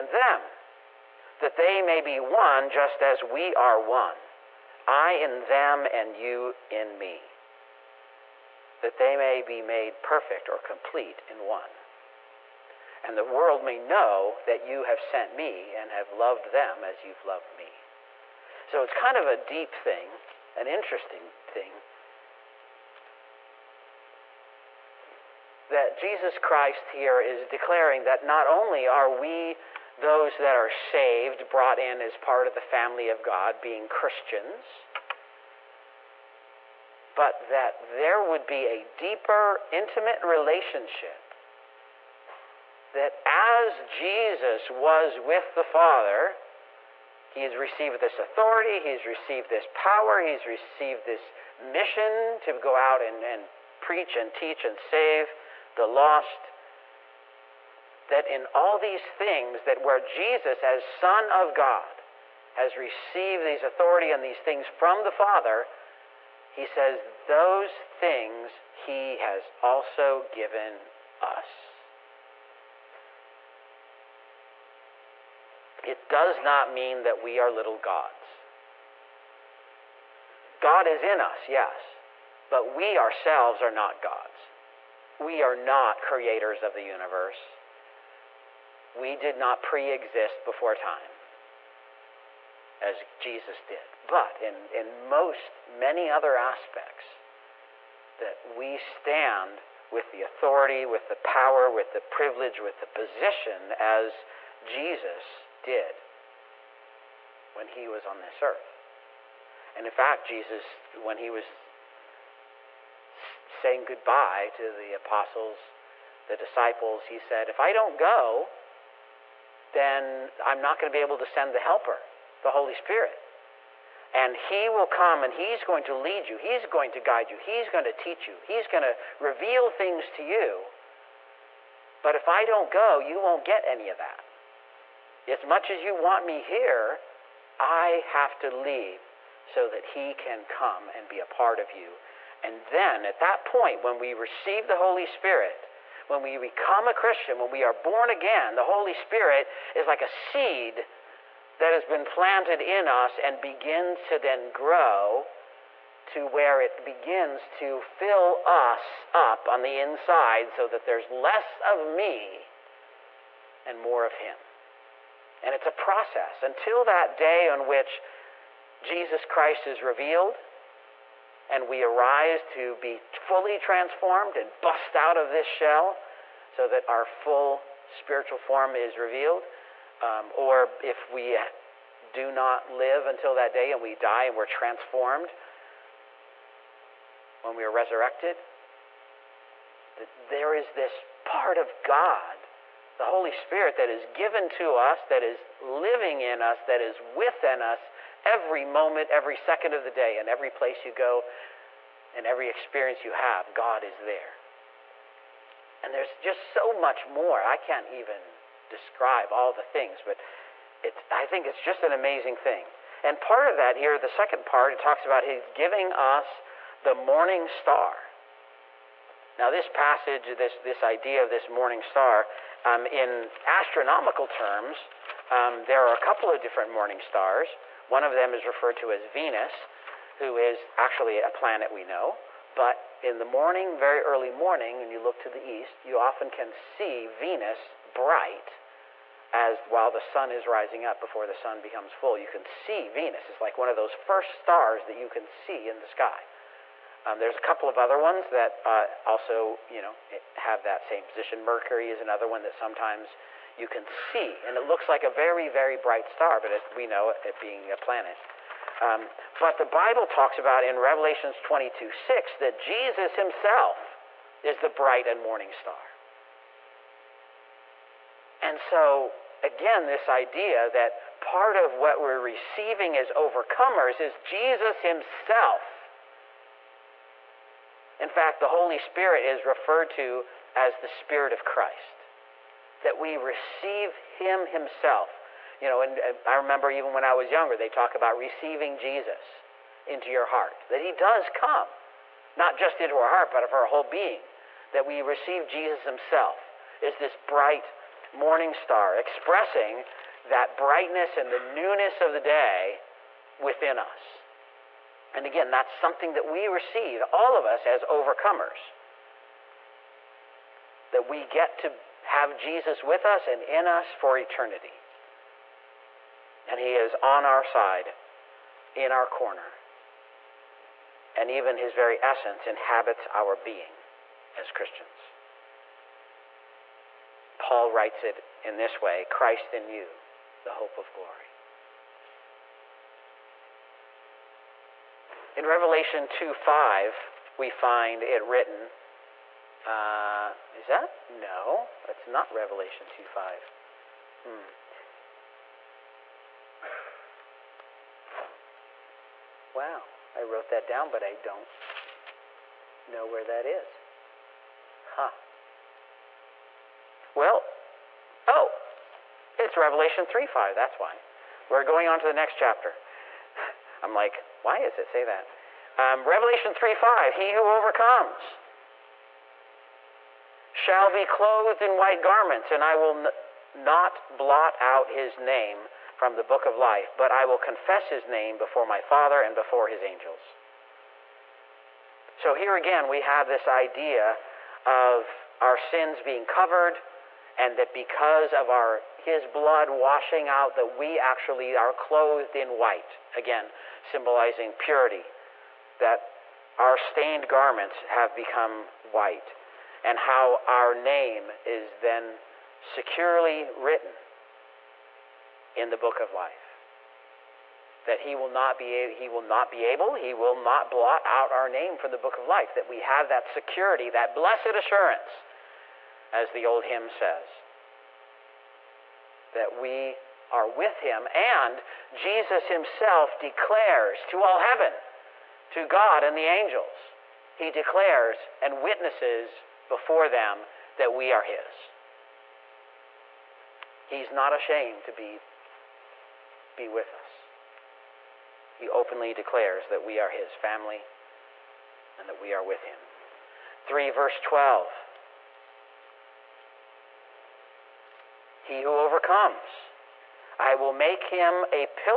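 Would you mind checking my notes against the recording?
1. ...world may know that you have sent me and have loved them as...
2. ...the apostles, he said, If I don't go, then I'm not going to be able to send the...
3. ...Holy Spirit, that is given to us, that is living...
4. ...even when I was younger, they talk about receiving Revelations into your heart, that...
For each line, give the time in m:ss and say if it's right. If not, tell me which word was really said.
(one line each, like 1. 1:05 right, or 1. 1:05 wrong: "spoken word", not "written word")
1. 0:13 right
2. 1:56 wrong: "disciples", not "apostles"
3. 3:13 right
4. 4:46 wrong: "Jesus", not "Revelations".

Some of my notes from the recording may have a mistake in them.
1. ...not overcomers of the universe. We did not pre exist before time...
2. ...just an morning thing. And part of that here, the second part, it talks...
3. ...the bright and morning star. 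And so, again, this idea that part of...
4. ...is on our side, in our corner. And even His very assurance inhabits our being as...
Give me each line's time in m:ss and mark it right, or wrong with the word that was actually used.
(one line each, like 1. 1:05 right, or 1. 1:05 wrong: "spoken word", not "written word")
1. 1:25 wrong: "creators", not "overcomers"
2. 3:31 wrong: "amazing", not "morning"
3. 4:24 right
4. 5:16 wrong: "essence", not "assurance".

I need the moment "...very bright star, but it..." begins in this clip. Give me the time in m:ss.
4:15.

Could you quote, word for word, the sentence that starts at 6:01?
We're going on to the next chapter.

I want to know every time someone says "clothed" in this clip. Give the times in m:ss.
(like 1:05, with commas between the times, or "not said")
6:11, 6:31.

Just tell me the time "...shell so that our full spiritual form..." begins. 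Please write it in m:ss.
2:55.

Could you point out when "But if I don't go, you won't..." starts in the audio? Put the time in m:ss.
2:12.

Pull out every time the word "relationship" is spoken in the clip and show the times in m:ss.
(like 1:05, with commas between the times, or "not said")
0:40.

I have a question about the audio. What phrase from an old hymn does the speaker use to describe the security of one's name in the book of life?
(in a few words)
Blessed assurance.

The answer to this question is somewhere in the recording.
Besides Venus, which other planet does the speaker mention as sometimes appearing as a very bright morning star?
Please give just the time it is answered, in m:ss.
4:11.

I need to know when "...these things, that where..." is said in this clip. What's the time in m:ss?
0:58.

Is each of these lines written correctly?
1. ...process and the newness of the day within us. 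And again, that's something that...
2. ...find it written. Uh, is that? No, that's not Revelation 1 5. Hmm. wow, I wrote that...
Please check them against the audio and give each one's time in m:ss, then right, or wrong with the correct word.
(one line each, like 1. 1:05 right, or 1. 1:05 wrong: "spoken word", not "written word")
1. 5:00 wrong: "brightness", not "process"
2. 5:37 wrong: "2", not "1".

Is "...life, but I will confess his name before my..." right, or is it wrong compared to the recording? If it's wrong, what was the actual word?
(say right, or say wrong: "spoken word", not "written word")
right.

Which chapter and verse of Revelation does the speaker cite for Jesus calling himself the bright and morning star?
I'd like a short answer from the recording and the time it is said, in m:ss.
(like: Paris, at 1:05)
Revelation 22:6, at 4:20.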